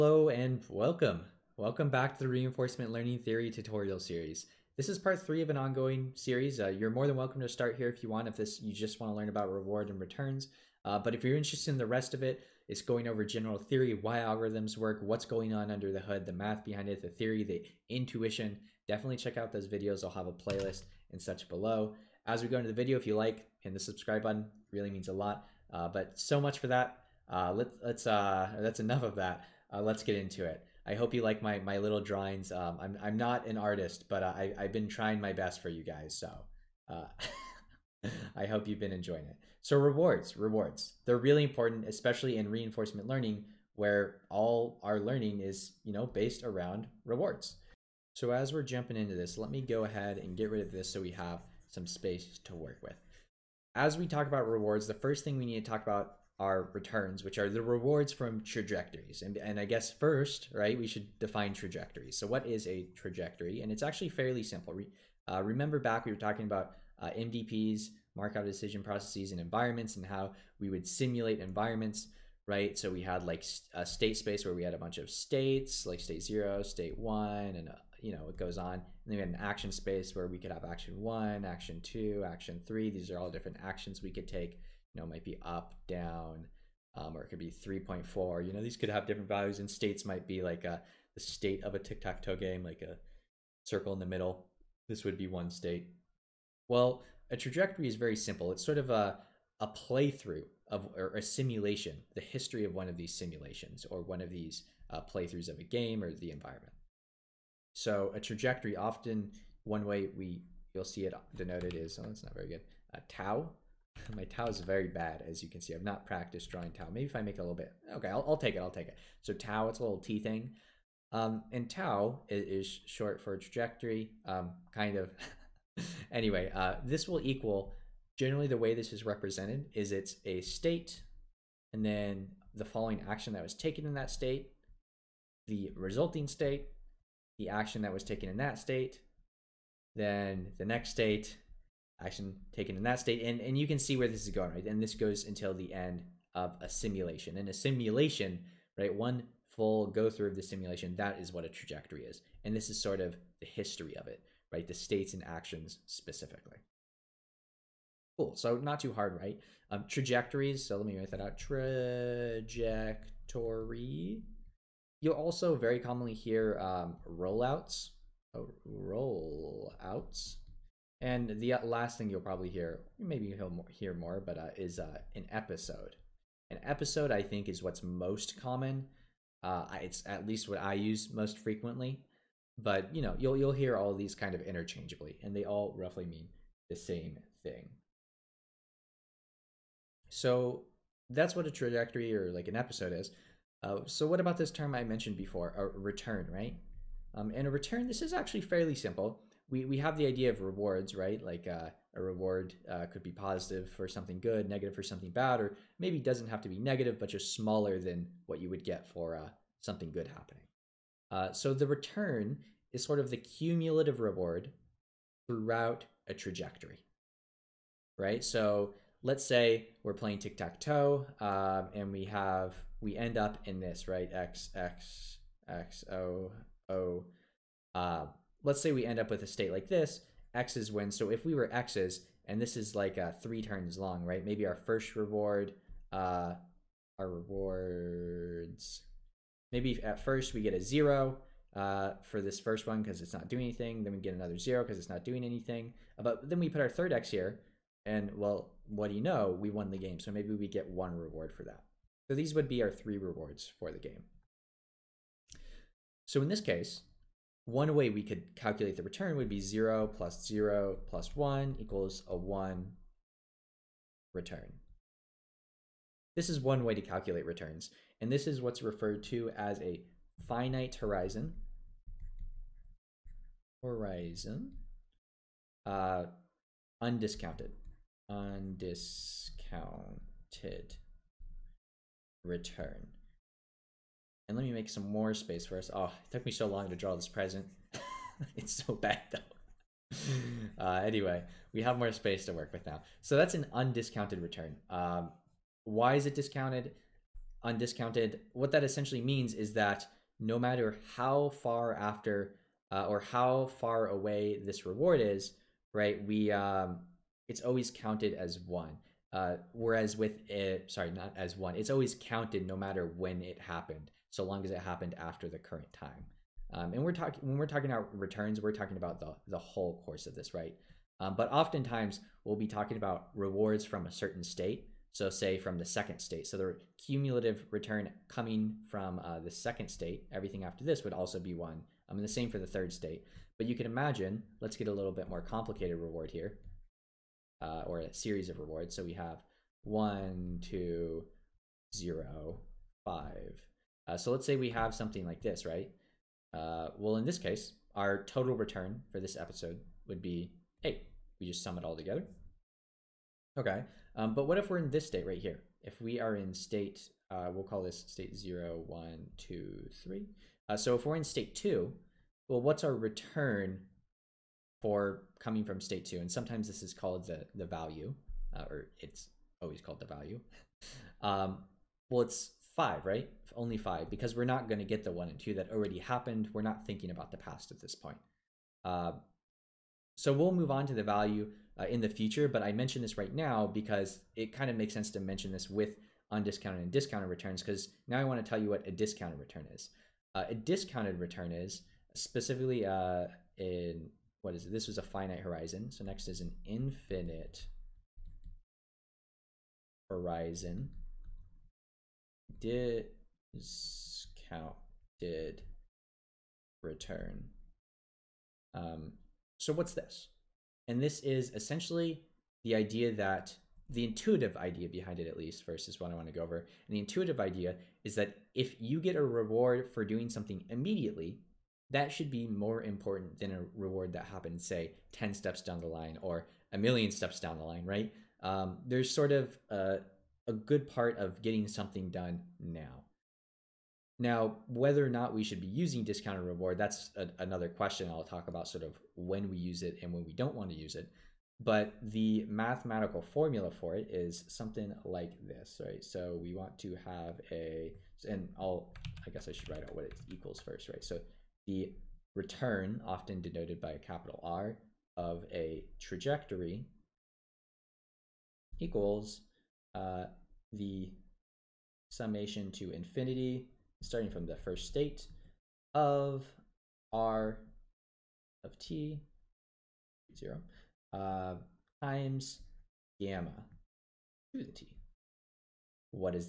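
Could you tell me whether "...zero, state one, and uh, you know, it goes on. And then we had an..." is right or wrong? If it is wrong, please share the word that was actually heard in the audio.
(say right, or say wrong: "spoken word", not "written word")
right.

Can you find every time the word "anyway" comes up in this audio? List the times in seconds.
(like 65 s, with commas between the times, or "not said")
126 s, 290 s.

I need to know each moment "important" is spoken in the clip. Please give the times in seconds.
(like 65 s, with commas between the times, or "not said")
41 s, 422 s.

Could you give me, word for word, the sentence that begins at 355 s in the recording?
If we are in state, uh, we'll call this state zero, one, two, three.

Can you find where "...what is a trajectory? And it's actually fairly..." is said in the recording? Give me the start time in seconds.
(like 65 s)
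62 s.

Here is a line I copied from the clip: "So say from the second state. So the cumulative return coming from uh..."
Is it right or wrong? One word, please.
right.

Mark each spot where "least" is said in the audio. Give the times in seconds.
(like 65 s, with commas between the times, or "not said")
180 s, 415 s.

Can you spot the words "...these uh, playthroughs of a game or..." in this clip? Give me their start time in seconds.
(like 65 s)
104 s.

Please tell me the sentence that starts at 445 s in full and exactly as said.
So we want to have a, and I'll, I guess I should write out what it equals first, right?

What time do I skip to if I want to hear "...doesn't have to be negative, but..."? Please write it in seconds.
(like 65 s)
205 s.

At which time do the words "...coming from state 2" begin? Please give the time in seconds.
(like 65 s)
365 s.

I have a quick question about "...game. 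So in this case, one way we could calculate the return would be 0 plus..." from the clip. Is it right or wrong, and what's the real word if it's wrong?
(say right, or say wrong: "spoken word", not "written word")
right.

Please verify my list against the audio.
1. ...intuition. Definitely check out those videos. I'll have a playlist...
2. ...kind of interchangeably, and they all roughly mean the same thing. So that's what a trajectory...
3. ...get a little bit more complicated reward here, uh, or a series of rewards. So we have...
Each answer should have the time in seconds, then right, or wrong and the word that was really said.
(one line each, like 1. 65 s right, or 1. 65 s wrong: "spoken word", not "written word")
1. 17 s right
2. 184 s right
3. 334 s right.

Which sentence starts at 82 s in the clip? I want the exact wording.
These are all different actions we could take you know, might be up, down, um, or it could be 3.4.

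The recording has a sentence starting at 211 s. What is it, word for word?
Uh, so the return is sort of the cumulative reward throughout a trajectory, right?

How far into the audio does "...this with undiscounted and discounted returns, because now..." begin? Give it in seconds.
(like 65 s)
385 s.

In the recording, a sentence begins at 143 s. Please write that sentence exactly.
And, and you can see where this is going, right?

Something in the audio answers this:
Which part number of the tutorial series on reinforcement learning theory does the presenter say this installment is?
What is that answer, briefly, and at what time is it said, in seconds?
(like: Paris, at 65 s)
Part 3, at 4 s.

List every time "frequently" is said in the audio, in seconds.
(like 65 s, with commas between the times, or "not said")
181 s.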